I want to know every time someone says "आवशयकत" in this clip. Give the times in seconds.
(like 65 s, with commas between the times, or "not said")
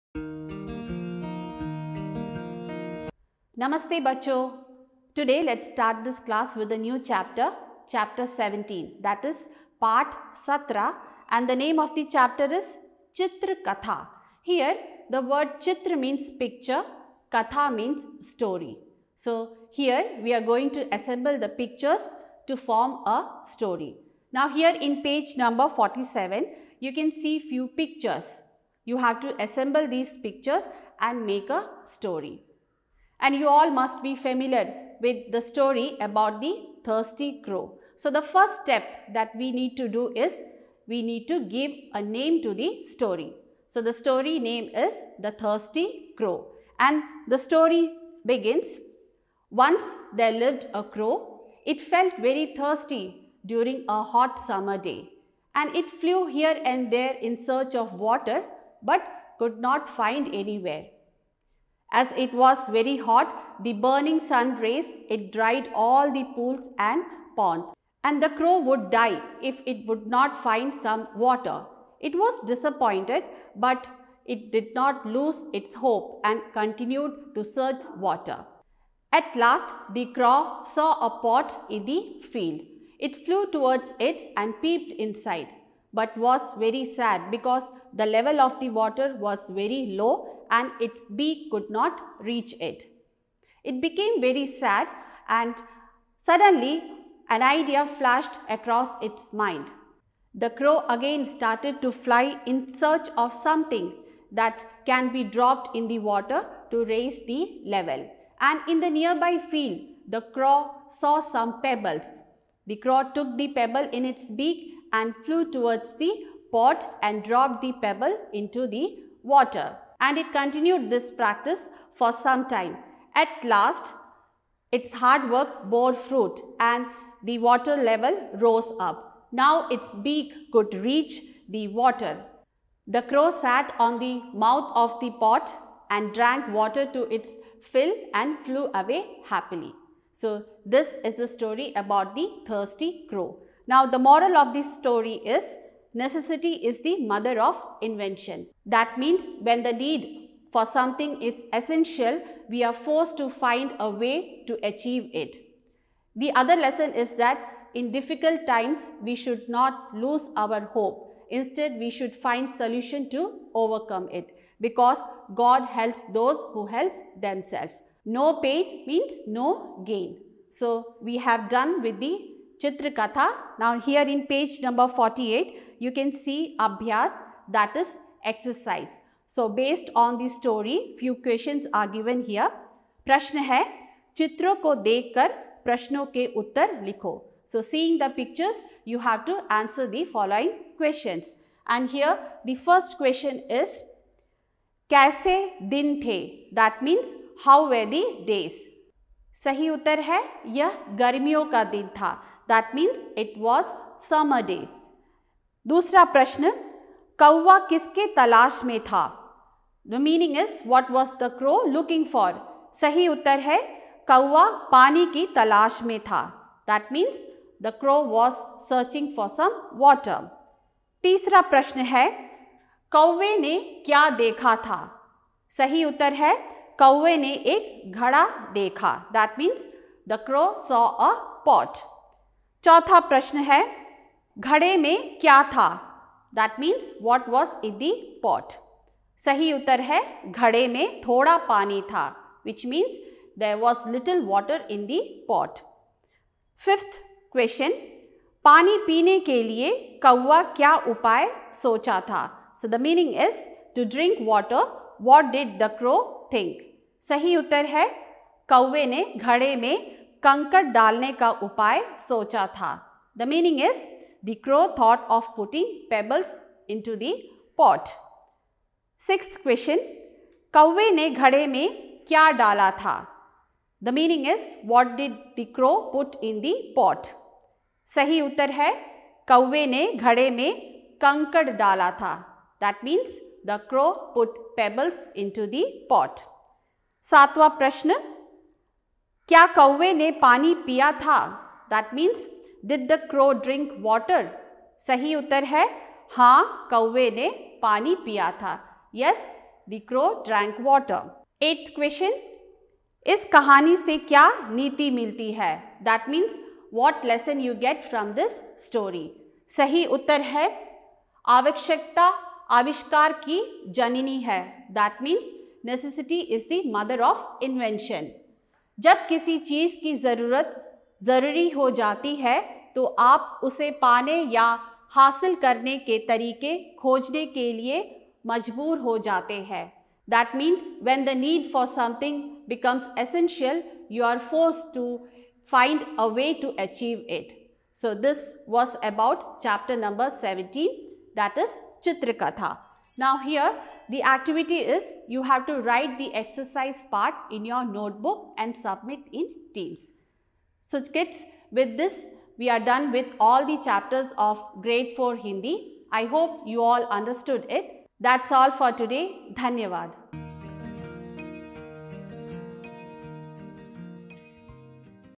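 311 s.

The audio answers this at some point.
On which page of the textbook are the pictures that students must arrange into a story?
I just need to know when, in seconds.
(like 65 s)
25 s.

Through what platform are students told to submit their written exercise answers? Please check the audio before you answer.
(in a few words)
Teams.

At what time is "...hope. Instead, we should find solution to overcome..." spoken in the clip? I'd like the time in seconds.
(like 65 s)
160 s.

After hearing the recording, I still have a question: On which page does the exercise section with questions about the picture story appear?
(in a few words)
48.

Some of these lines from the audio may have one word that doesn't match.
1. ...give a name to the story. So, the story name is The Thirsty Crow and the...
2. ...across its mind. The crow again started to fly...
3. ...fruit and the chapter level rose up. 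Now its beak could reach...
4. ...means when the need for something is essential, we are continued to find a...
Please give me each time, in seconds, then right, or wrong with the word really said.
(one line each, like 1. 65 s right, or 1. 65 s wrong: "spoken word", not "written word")
1. 41 s right
2. 98 s right
3. 125 s wrong: "water", not "chapter"
4. 148 s wrong: "forced", not "continued".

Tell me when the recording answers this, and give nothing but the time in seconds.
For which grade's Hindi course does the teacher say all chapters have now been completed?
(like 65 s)
354 s.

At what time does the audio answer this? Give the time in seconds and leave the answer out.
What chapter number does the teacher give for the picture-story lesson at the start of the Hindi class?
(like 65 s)
7 s.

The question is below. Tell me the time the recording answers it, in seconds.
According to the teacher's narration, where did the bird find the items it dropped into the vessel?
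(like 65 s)
108 s.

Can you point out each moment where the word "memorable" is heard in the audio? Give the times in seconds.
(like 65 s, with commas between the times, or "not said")
not said.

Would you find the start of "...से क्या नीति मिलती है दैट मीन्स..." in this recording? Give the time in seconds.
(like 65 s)
303 s.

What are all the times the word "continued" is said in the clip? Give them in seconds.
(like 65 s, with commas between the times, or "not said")
76 s, 120 s.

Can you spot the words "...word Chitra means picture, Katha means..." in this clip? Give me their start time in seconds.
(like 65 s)
15 s.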